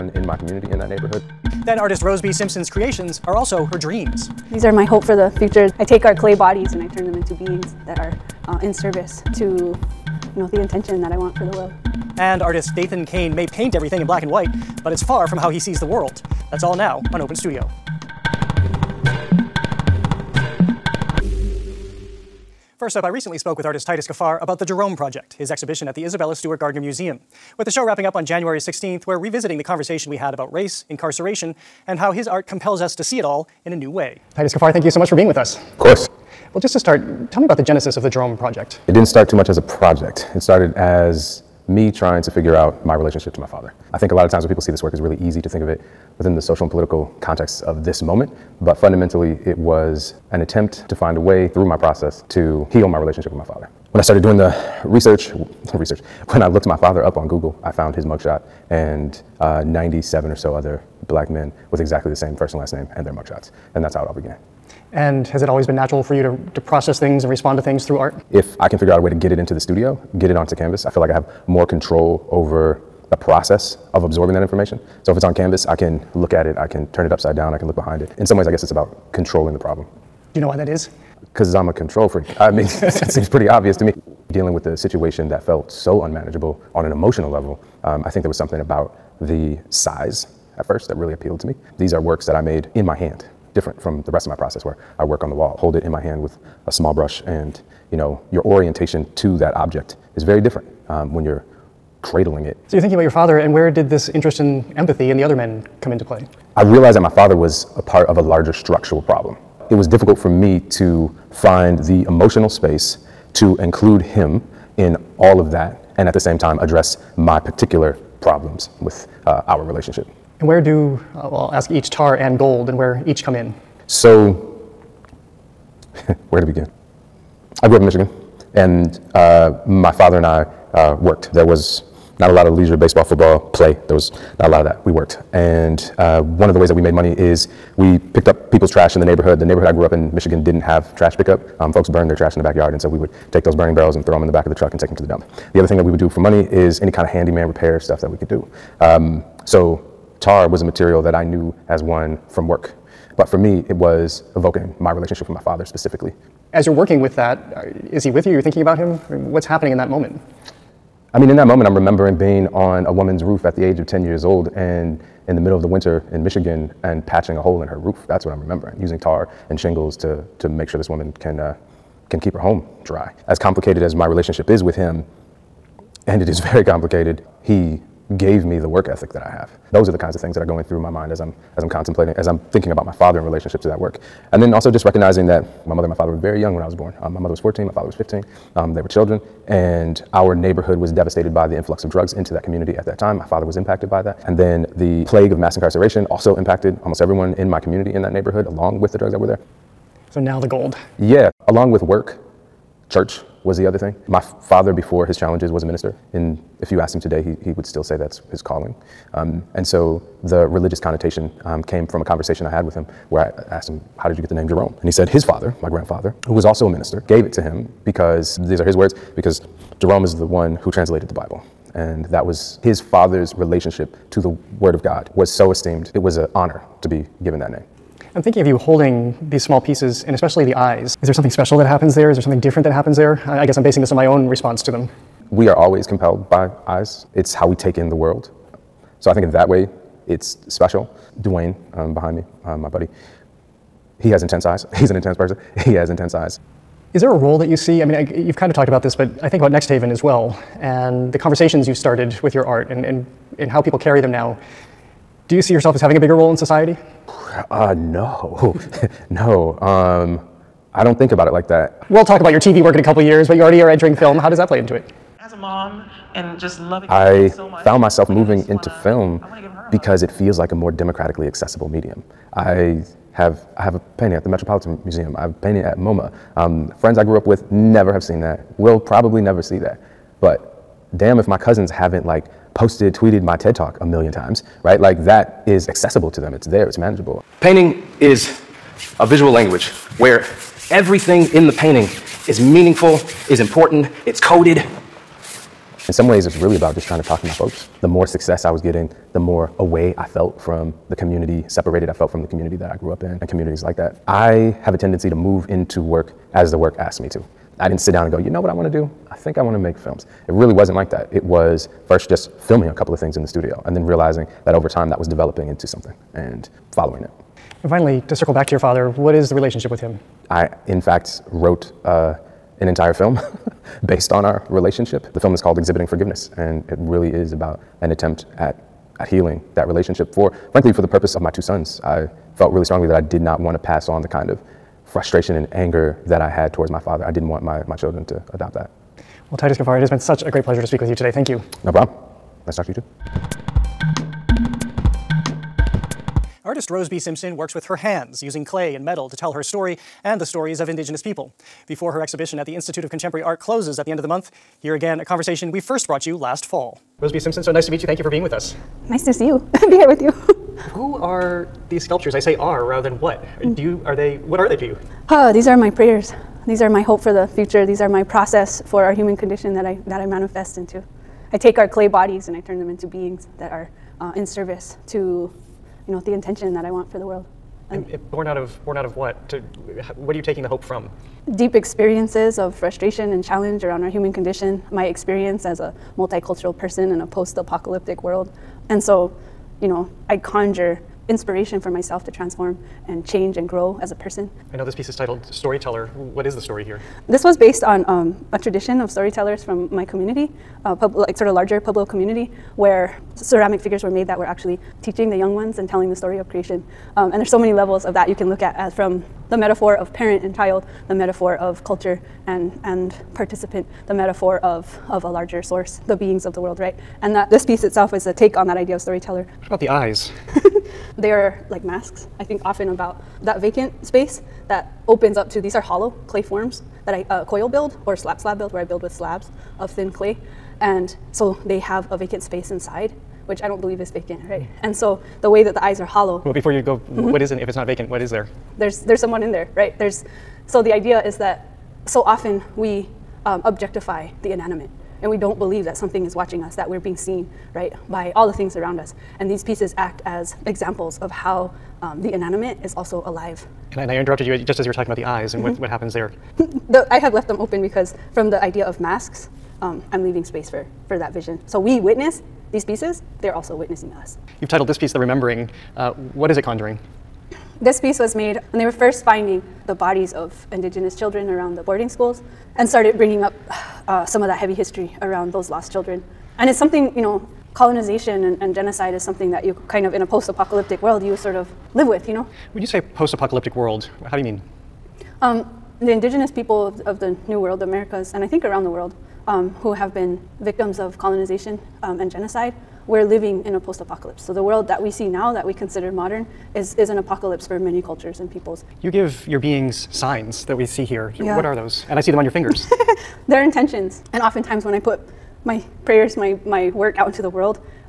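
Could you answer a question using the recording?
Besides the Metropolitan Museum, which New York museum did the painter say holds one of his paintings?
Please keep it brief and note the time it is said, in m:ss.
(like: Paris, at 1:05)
MoMA, at 4:35.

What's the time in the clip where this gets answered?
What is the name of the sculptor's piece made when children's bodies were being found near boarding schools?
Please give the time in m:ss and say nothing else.
7:44.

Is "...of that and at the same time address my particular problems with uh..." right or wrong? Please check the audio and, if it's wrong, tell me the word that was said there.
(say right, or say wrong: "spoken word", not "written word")
right.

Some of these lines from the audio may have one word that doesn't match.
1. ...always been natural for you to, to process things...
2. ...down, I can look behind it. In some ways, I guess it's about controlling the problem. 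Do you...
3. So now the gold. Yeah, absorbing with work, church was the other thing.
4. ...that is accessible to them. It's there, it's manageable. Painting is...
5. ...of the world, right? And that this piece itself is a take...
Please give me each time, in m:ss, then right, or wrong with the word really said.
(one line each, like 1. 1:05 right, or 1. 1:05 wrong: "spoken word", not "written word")
1. 1:05 right
2. 1:17 right
3. 3:20 wrong: "along", not "absorbing"
4. 4:45 right
5. 6:56 right.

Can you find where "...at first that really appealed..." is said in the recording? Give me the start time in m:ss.
1:30.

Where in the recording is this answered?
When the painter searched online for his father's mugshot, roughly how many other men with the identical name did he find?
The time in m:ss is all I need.
0:59.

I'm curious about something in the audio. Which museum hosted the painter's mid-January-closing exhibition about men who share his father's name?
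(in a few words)
Isabella Stewart Gardner Museum.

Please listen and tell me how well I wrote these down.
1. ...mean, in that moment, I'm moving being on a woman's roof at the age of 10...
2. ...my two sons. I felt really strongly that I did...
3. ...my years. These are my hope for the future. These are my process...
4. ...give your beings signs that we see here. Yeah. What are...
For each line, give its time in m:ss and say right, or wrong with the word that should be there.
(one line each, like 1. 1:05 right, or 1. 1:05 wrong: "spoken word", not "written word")
1. 2:41 wrong: "remembering", not "moving"
2. 5:31 right
3. 6:05 wrong: "prayers", not "years"
4. 8:18 right.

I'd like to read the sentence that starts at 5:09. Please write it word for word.
I think I want to make films.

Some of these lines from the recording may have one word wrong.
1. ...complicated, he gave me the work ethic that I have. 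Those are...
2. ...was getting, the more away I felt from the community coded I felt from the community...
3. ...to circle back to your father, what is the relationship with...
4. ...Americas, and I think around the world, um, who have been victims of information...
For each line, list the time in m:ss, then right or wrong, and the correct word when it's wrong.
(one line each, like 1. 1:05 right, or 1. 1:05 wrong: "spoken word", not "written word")
1. 2:56 right
2. 4:58 wrong: "separated", not "coded"
3. 5:18 right
4. 8:07 wrong: "colonization", not "information".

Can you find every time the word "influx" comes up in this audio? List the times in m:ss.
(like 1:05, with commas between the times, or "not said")
3:11.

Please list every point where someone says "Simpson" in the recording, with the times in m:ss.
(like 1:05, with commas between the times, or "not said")
0:02, 5:46, 5:57.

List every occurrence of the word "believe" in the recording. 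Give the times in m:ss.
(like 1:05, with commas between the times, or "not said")
7:13, 7:25.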